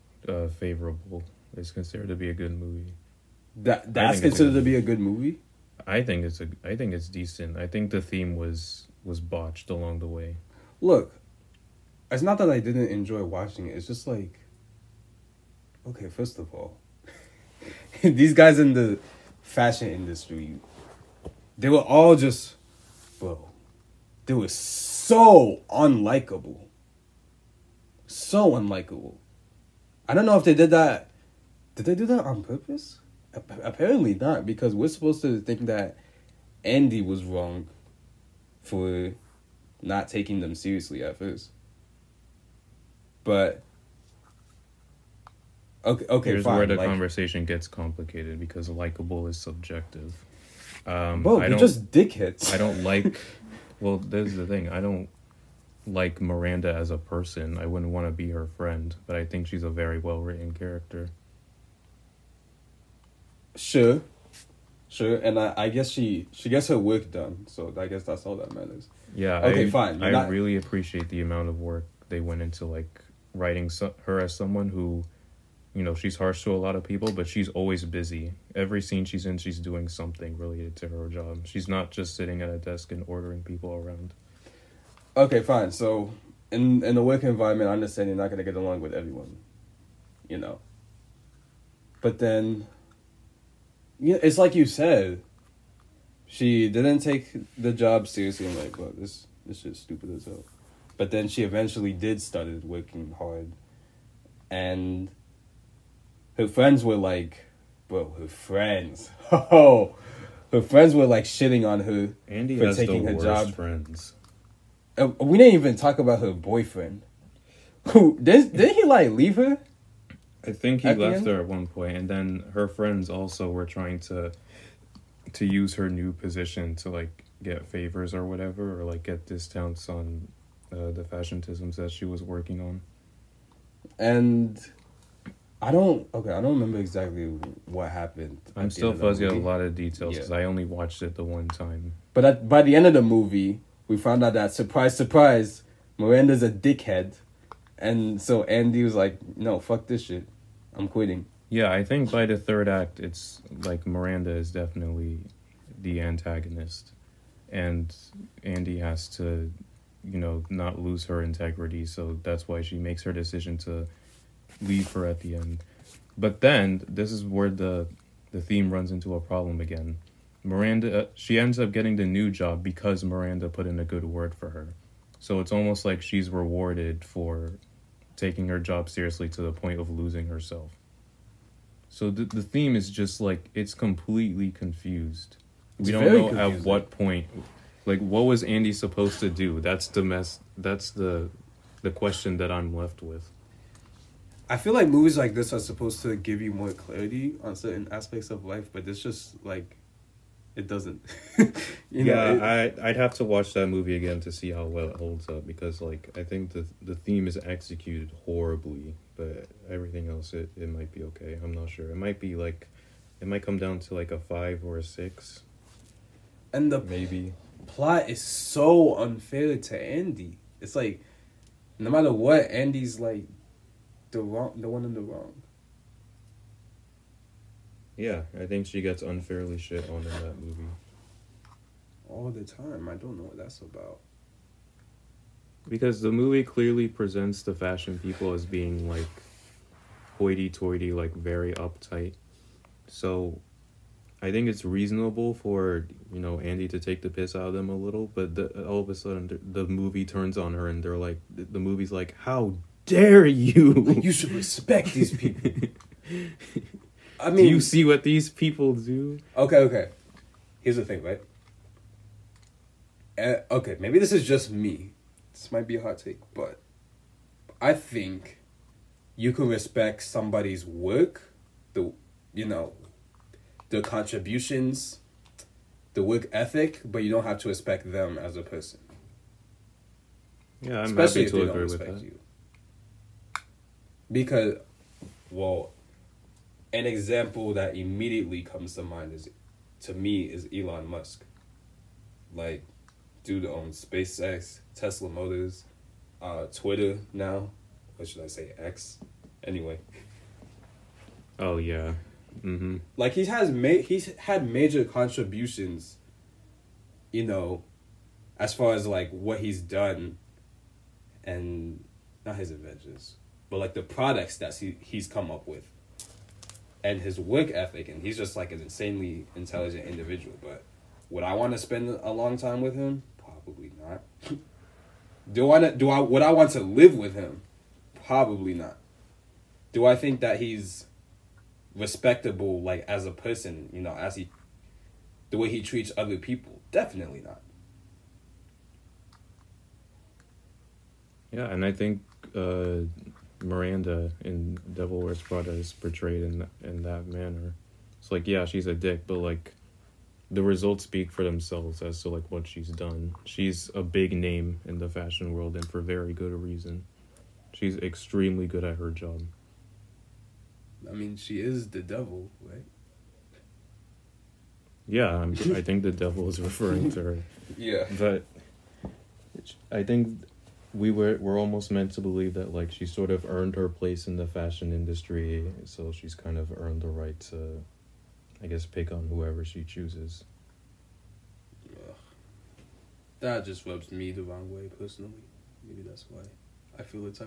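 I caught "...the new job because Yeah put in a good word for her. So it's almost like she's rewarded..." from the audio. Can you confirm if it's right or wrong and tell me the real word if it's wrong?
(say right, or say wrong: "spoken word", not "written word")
wrong: "Miranda", not "Yeah".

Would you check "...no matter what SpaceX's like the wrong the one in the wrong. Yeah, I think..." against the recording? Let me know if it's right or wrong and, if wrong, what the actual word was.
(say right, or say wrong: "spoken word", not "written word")
wrong: "Andy", not "SpaceX".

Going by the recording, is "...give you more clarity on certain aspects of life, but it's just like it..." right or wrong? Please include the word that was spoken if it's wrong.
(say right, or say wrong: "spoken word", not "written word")
right.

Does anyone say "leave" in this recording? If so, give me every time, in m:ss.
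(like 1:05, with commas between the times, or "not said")
1:59, 2:44.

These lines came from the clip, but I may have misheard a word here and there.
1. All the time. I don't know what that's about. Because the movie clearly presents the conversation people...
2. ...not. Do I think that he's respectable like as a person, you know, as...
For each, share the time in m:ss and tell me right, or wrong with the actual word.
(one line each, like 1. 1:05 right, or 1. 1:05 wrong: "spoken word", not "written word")
1. 3:52 wrong: "fashion", not "conversation"
2. 5:28 right.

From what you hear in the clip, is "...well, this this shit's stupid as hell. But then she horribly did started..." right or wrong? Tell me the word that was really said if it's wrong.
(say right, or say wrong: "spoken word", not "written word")
wrong: "eventually", not "horribly".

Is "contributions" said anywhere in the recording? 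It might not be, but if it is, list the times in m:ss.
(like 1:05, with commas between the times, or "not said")
4:33, 5:04.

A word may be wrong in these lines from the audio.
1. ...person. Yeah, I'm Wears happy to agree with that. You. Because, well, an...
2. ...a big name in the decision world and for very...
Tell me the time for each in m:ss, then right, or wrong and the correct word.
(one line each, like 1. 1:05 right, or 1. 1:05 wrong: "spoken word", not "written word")
1. 4:38 wrong: "Especially", not "Wears"
2. 5:53 wrong: "fashion", not "decision".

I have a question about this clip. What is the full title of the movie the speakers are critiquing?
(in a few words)
Devil Wears Prada.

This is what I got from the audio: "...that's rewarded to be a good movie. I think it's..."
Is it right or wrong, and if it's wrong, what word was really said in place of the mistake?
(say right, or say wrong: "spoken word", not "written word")
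wrong: "considered", not "rewarded".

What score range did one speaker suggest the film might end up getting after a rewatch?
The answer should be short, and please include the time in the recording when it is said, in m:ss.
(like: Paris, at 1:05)
5 or 6, at 3:34.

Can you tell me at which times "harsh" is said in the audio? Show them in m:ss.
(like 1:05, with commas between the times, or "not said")
1:16.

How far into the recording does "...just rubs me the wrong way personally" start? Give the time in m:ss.
6:23.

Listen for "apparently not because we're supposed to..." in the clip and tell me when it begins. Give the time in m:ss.
0:33.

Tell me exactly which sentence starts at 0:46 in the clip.
where the like, conversation gets complicated because likable is subjective.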